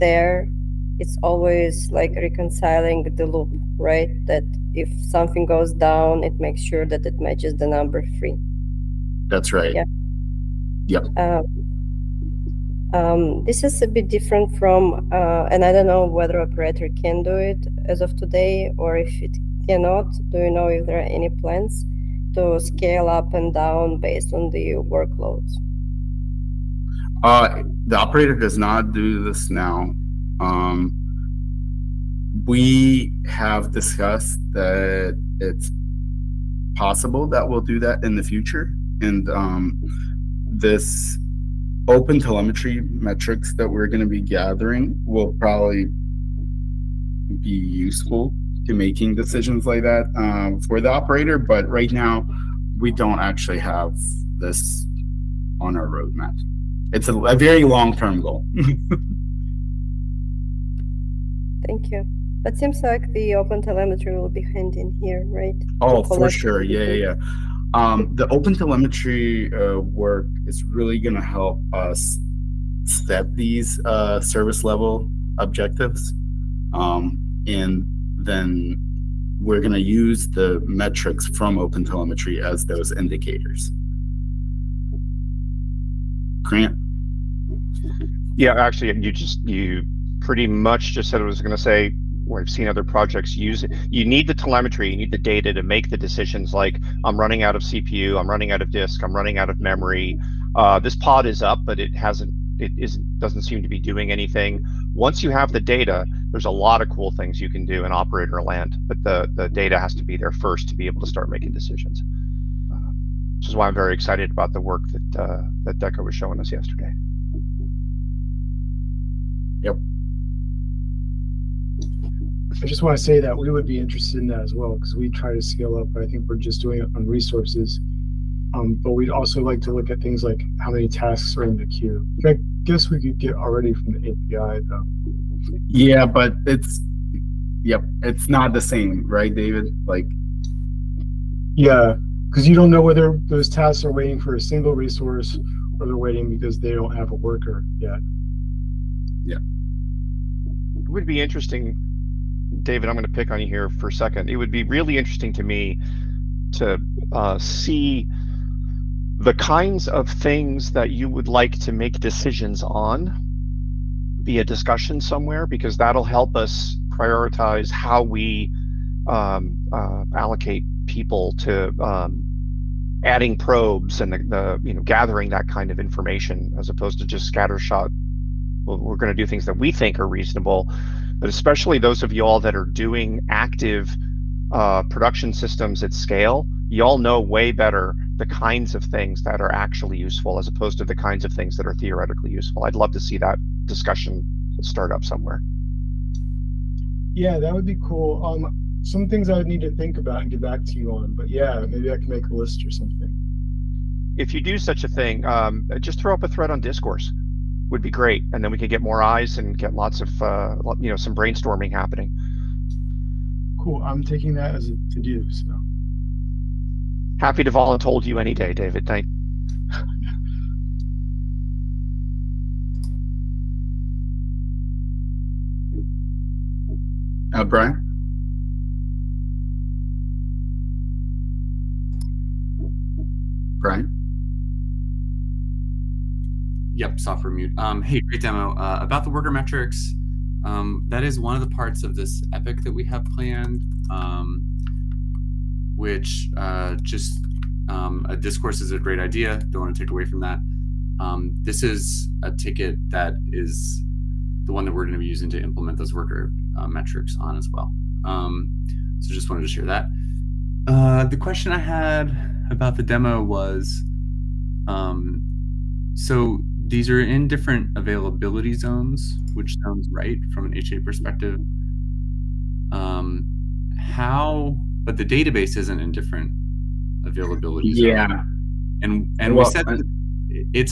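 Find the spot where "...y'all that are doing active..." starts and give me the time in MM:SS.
03:02.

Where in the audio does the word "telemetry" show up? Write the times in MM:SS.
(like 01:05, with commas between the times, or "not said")
00:42, 01:03, 01:08, 01:21, 01:34.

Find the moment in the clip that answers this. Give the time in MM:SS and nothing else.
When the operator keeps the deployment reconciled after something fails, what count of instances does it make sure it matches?
00:07.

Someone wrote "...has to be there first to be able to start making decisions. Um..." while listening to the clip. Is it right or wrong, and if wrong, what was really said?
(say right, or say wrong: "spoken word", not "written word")
right.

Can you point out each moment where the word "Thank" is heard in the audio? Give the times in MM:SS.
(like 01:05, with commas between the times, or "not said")
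01:01, 03:38.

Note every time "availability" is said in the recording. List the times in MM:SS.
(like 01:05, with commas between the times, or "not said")
04:27, 04:37.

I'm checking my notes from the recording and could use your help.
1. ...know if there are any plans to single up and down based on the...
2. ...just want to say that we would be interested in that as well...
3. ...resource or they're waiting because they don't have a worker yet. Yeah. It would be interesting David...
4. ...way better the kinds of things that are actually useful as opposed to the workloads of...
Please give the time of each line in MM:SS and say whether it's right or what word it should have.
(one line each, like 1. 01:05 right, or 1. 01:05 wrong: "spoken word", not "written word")
1. 00:20 wrong: "scale", not "single"
2. 02:02 right
3. 02:24 right
4. 03:07 wrong: "kinds", not "workloads".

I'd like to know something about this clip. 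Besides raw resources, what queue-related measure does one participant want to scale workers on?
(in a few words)
how many tasks are in the queue.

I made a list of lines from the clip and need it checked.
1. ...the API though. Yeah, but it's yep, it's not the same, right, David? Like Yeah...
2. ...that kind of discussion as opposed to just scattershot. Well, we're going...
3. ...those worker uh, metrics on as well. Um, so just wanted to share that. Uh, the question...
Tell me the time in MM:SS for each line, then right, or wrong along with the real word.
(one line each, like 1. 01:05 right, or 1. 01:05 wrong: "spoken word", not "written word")
1. 02:13 right
2. 02:55 wrong: "information", not "discussion"
3. 04:15 right.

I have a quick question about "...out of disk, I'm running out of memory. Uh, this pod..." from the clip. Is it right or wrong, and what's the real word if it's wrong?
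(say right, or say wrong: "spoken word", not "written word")
right.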